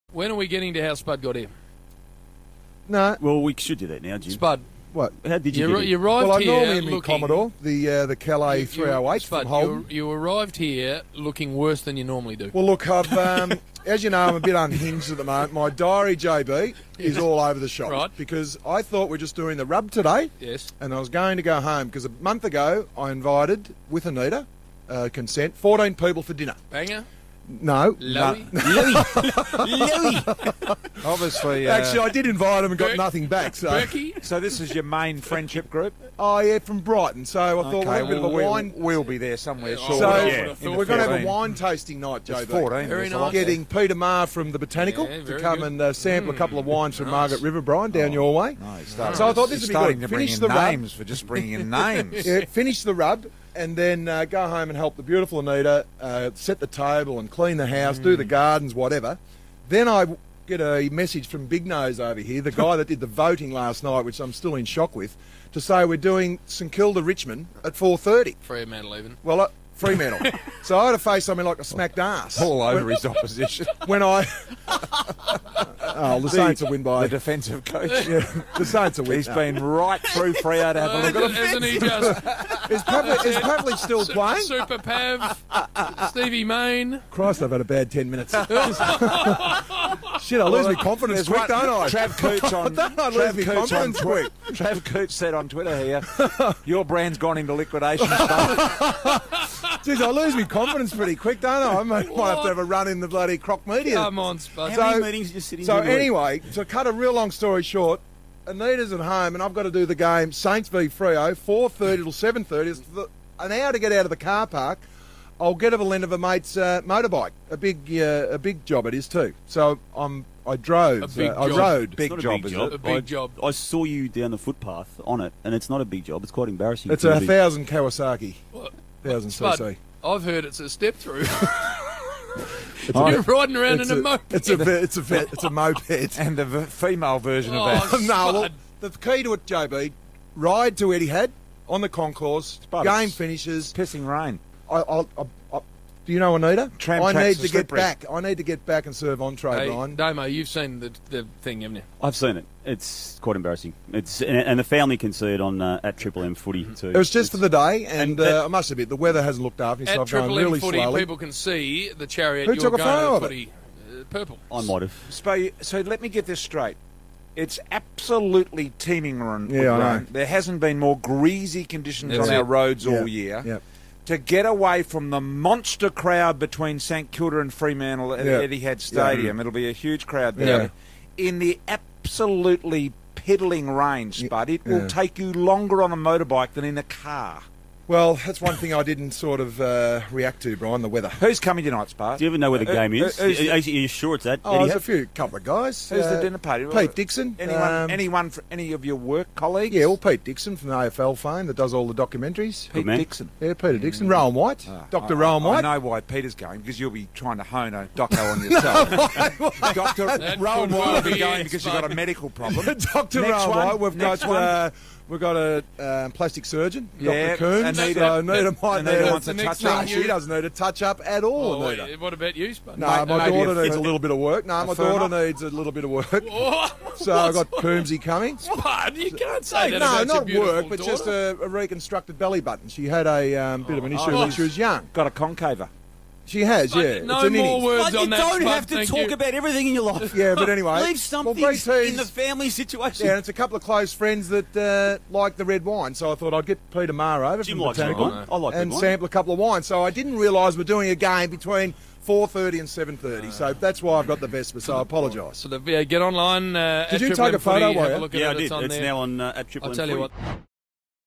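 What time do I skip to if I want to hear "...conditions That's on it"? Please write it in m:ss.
2:51.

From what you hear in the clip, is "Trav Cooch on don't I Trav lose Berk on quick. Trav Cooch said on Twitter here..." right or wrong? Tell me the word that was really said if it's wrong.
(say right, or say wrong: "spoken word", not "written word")
wrong: "Cooch", not "Berk".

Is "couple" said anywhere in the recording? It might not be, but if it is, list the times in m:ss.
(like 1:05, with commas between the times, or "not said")
0:46, 3:15, 4:03, 4:09.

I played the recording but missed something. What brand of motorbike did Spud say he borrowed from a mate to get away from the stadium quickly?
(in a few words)
Kawasaki.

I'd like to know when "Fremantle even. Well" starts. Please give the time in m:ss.
1:08.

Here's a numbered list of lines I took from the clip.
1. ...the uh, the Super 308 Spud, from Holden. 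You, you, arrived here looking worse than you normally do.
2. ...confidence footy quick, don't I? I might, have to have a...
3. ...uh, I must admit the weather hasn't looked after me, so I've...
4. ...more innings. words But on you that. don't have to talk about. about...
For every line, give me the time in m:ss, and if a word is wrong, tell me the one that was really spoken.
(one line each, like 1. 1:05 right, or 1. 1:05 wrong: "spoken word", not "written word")
1. 0:07 wrong: "Calais", not "Super"
2. 1:40 wrong: "pretty", not "footy"
3. 2:38 right
4. 3:57 right.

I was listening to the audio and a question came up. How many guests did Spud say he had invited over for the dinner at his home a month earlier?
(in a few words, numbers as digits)
14.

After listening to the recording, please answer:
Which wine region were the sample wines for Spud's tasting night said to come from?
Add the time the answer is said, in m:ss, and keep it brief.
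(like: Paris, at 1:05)
Margaret River, at 0:47.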